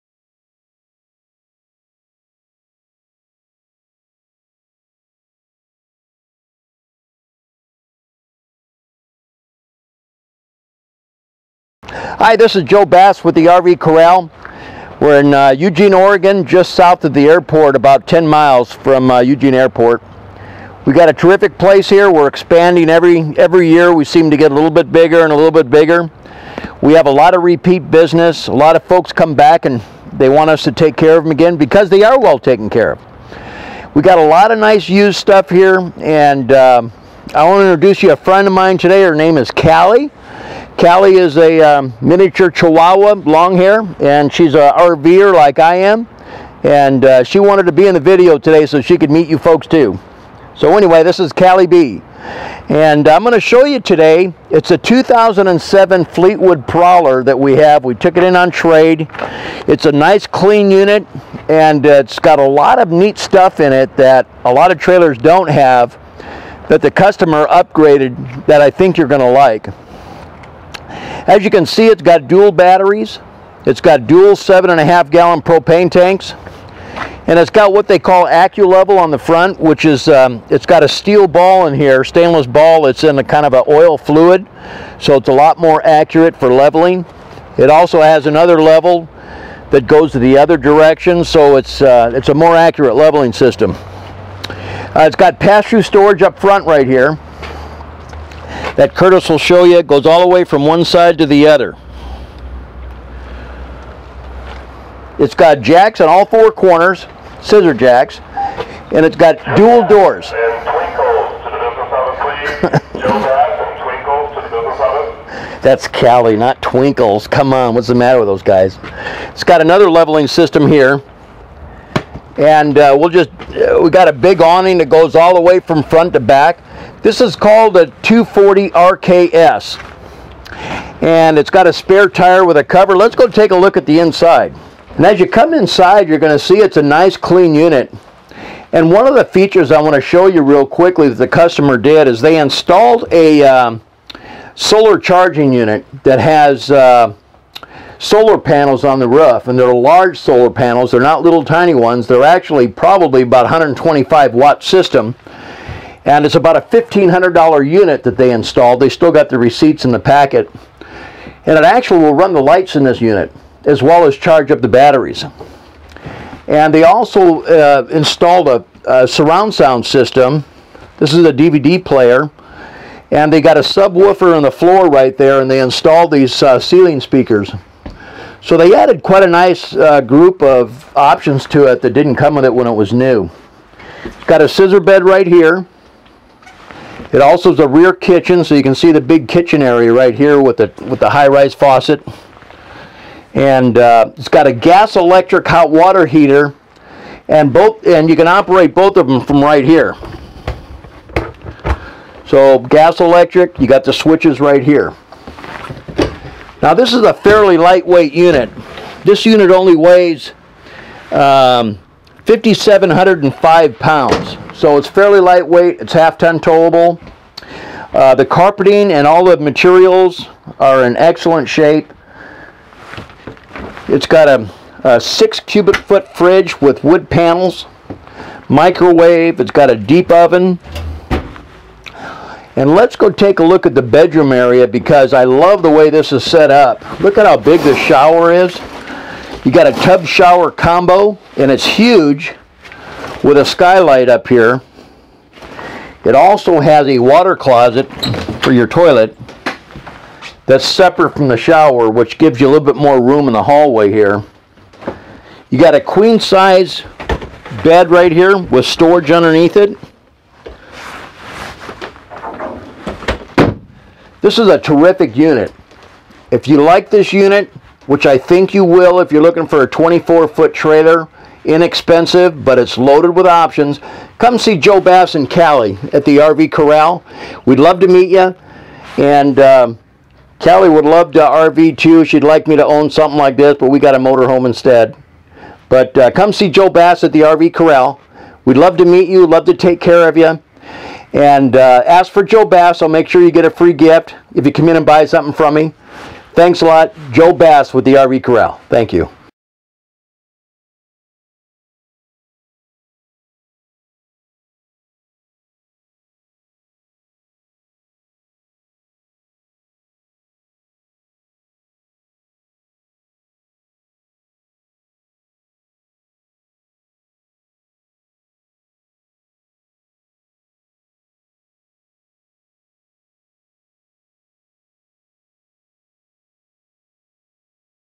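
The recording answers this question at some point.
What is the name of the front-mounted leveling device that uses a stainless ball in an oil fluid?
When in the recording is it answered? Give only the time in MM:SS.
01:18.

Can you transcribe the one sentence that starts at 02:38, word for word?
They still got the receipts in the packet.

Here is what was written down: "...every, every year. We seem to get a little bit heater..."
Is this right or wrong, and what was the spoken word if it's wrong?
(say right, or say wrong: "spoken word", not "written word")
wrong: "bigger", not "heater".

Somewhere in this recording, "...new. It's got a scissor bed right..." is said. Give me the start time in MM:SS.
03:02.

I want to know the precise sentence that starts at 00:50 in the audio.
So anyway, this is Callie B.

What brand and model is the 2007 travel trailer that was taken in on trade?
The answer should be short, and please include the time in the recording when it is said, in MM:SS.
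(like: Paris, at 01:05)
Fleetwood Prowler, at 00:56.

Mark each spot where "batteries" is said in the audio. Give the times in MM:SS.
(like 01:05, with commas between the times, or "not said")
01:12, 02:44.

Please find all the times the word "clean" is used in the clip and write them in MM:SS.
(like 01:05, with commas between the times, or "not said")
01:00, 02:17.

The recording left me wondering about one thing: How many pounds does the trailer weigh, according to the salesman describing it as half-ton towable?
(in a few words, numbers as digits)
5,705 pounds.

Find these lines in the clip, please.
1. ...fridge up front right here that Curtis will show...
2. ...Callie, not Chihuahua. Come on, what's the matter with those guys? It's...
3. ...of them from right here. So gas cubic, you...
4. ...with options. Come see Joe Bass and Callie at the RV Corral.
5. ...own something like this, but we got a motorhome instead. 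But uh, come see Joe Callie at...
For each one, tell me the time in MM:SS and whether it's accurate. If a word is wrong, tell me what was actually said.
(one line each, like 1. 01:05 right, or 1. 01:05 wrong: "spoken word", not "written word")
1. 01:35 wrong: "storage", not "fridge"
2. 01:55 wrong: "Twinkles", not "Chihuahua"
3. 03:18 wrong: "electric", not "cubic"
4. 04:33 right
5. 04:42 wrong: "Bass", not "Callie".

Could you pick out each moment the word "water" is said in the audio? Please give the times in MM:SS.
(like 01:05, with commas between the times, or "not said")
03:15, 04:06.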